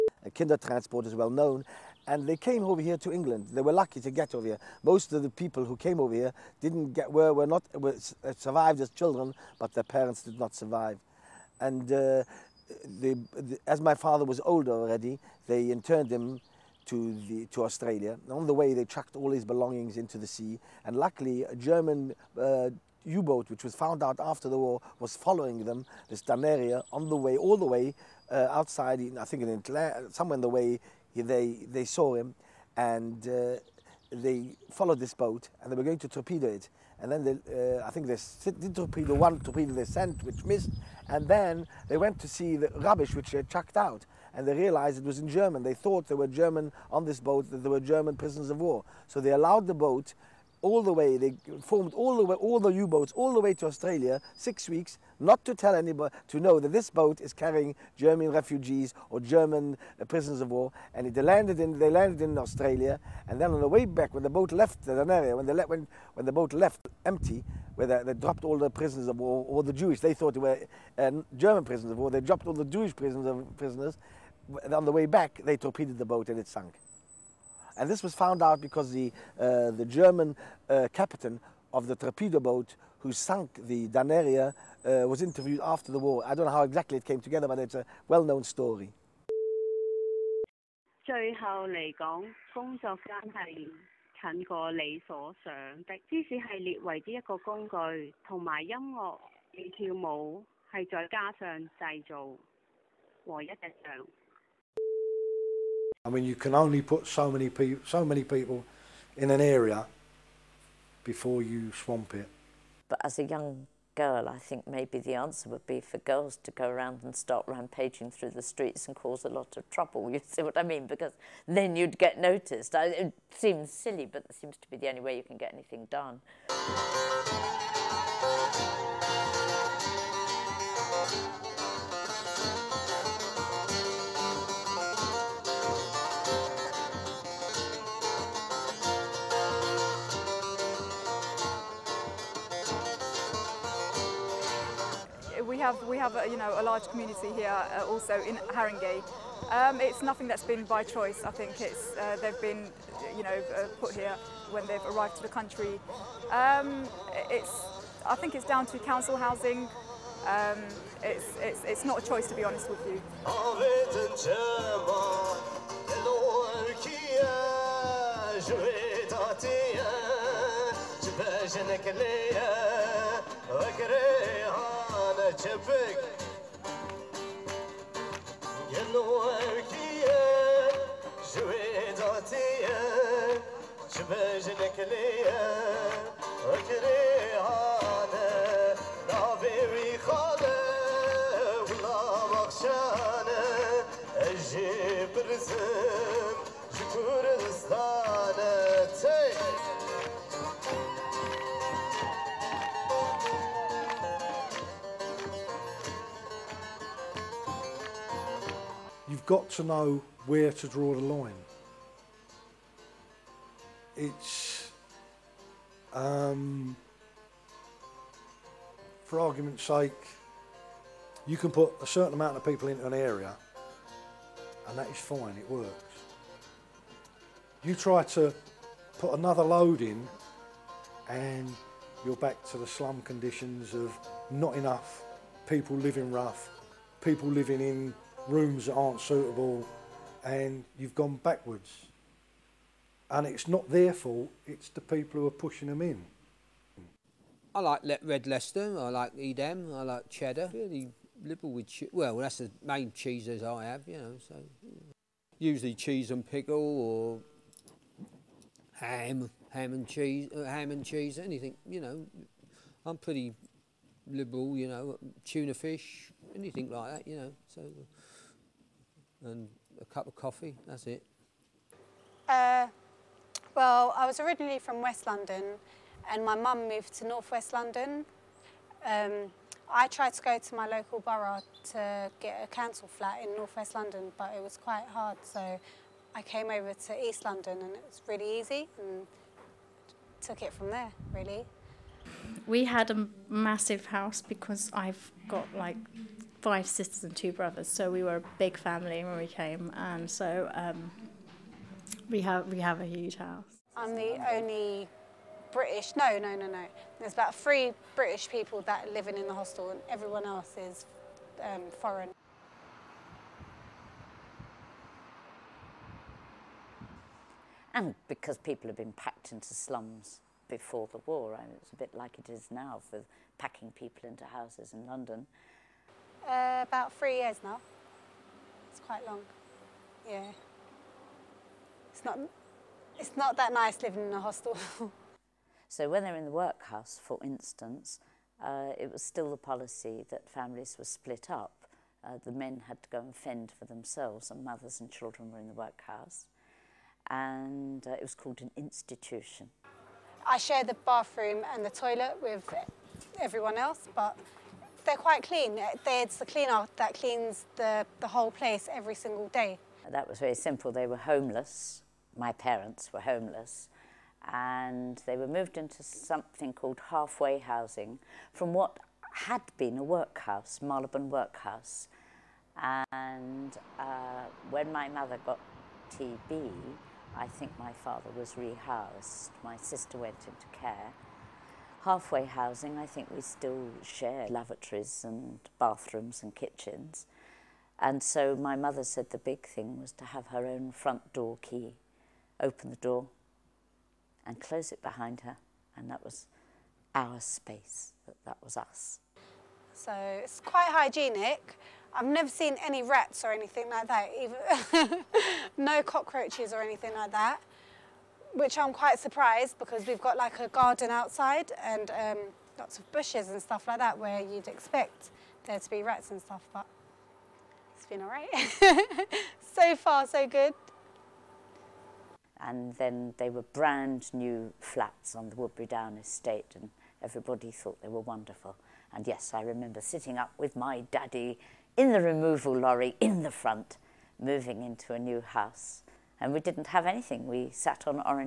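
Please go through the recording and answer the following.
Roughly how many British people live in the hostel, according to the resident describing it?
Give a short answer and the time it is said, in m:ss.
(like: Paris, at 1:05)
3, at 5:07.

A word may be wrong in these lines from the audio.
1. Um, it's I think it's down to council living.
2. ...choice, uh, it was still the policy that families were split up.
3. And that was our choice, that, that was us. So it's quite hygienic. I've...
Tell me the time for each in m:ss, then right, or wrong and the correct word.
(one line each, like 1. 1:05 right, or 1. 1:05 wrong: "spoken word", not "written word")
1. 2:36 wrong: "housing", not "living"
2. 5:37 wrong: "instance", not "choice"
3. 6:35 wrong: "space", not "choice".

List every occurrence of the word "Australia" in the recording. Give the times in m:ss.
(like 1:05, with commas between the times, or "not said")
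0:17, 0:53, 1:02.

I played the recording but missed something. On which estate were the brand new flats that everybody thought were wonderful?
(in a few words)
Woodberry Down.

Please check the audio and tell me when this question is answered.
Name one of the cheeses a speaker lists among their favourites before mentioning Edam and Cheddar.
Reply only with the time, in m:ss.
4:08.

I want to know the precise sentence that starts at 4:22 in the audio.
I'm pretty liberal, you know, tuna fish, anything like that, you know.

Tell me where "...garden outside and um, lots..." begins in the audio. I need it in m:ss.
6:50.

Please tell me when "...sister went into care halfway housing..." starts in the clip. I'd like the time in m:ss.
6:19.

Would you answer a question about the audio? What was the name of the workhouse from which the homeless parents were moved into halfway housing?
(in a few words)
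Marlborough Workhouse.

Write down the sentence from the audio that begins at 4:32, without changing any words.
Uh, well, I was originally from West London, and my mum moved to Northwest London.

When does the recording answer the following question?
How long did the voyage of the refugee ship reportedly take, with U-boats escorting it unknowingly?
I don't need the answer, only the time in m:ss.
0:54.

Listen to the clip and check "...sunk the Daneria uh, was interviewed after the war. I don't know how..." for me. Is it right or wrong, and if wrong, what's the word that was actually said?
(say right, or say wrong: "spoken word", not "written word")
right.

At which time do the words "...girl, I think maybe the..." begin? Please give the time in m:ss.
1:53.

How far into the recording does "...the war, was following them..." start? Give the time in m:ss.
0:24.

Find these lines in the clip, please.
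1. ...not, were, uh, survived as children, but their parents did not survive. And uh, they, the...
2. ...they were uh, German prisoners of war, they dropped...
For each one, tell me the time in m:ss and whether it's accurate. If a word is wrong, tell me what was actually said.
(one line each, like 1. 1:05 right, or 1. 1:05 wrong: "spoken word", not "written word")
1. 0:07 right
2. 1:10 right.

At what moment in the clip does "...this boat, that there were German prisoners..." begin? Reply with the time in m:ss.
0:47.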